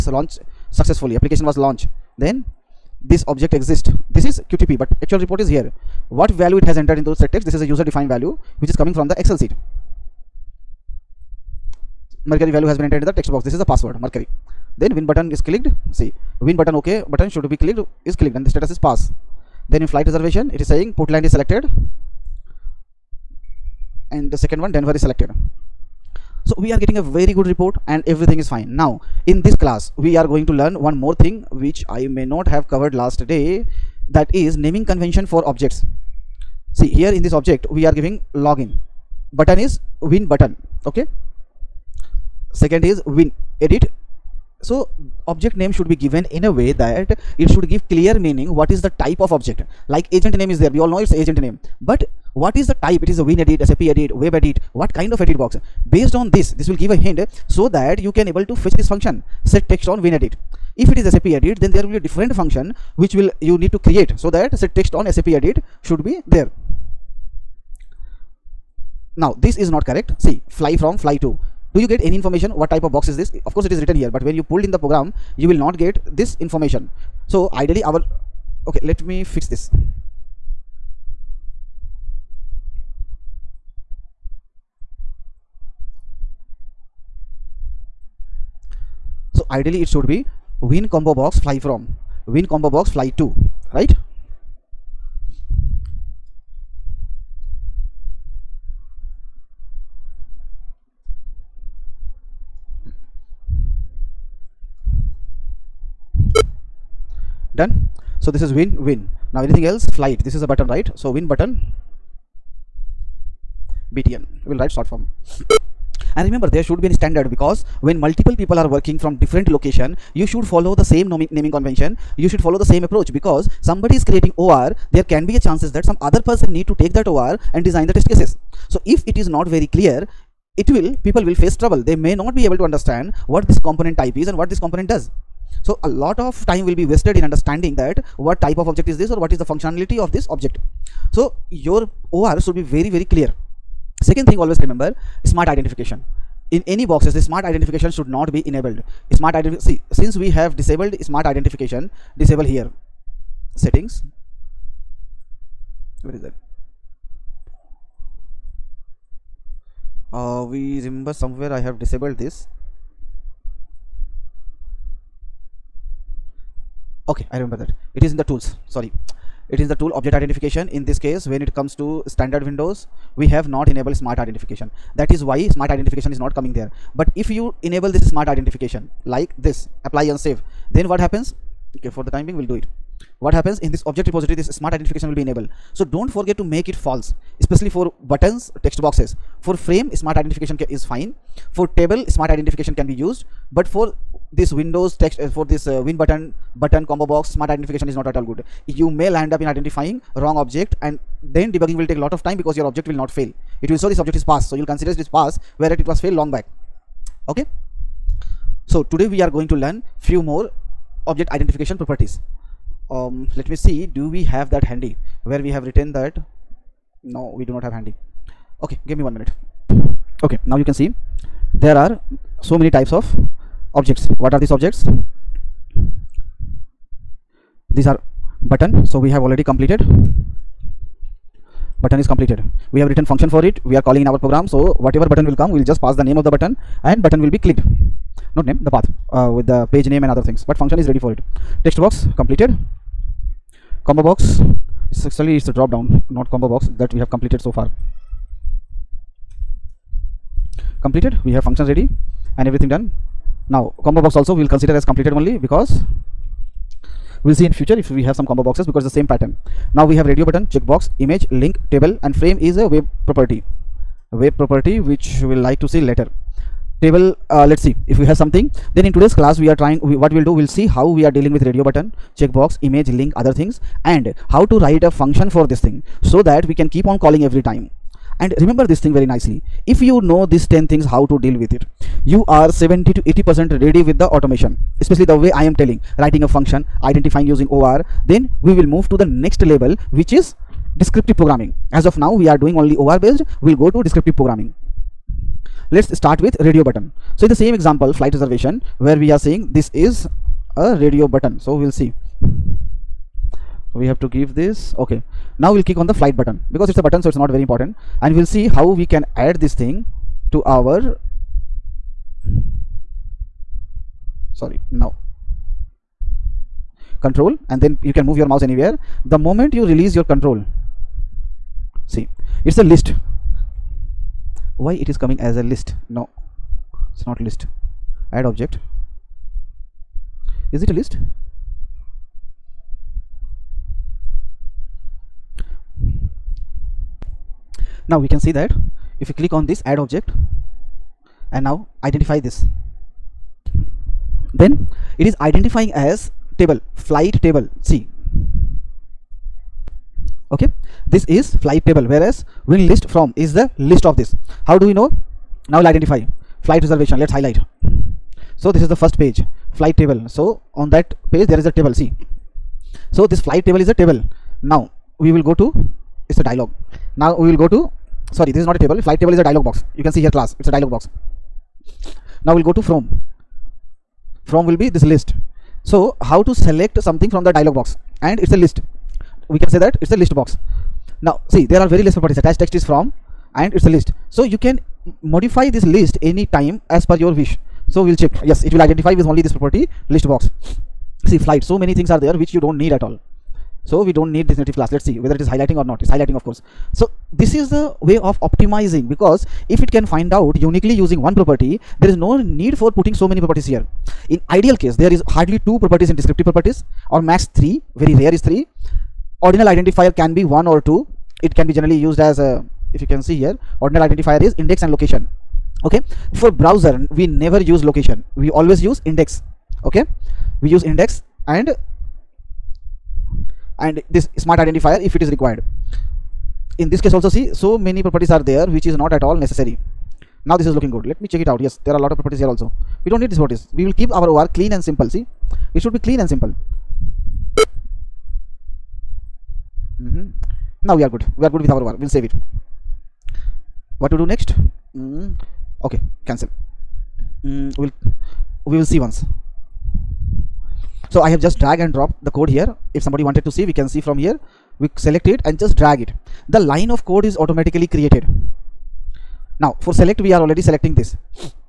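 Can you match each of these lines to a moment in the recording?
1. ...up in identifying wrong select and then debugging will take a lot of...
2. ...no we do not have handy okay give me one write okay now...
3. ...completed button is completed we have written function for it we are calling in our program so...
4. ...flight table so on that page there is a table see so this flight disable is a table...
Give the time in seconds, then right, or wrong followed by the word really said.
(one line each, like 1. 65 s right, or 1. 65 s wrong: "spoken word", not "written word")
1. 199 s wrong: "object", not "select"
2. 217 s wrong: "minute", not "write"
3. 229 s right
4. 359 s wrong: "table", not "disable".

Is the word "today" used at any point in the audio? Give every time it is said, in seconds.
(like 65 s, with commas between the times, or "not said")
208 s, 268 s.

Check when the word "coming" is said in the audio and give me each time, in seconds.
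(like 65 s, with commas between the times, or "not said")
8 s, 176 s, 325 s.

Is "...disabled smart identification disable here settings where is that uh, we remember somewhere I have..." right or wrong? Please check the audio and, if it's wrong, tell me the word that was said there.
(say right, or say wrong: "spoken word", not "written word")
right.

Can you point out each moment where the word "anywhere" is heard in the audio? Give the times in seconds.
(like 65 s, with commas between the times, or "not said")
318 s.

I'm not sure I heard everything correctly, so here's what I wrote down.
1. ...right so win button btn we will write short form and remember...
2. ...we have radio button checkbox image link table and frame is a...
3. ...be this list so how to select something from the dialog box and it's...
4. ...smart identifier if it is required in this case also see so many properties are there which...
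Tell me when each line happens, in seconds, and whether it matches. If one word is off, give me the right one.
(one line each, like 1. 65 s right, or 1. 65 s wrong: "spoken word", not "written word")
1. 110 s right
2. 259 s right
3. 374 s right
4. 424 s right.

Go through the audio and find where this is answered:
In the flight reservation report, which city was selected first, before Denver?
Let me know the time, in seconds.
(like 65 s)
20 s.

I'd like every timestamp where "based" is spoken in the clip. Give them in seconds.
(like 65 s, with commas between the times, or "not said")
55 s, 292 s.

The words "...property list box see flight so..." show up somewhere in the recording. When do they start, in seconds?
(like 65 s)
389 s.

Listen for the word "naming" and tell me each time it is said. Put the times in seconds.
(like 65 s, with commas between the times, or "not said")
34 s, 121 s.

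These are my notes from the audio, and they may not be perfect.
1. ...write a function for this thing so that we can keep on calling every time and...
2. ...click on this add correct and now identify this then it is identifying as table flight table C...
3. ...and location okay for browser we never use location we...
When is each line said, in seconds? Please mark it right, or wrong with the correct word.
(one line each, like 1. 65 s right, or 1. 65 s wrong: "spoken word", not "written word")
1. 274 s right
2. 339 s wrong: "object", not "correct"
3. 414 s right.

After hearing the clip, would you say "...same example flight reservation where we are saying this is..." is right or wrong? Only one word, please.
right.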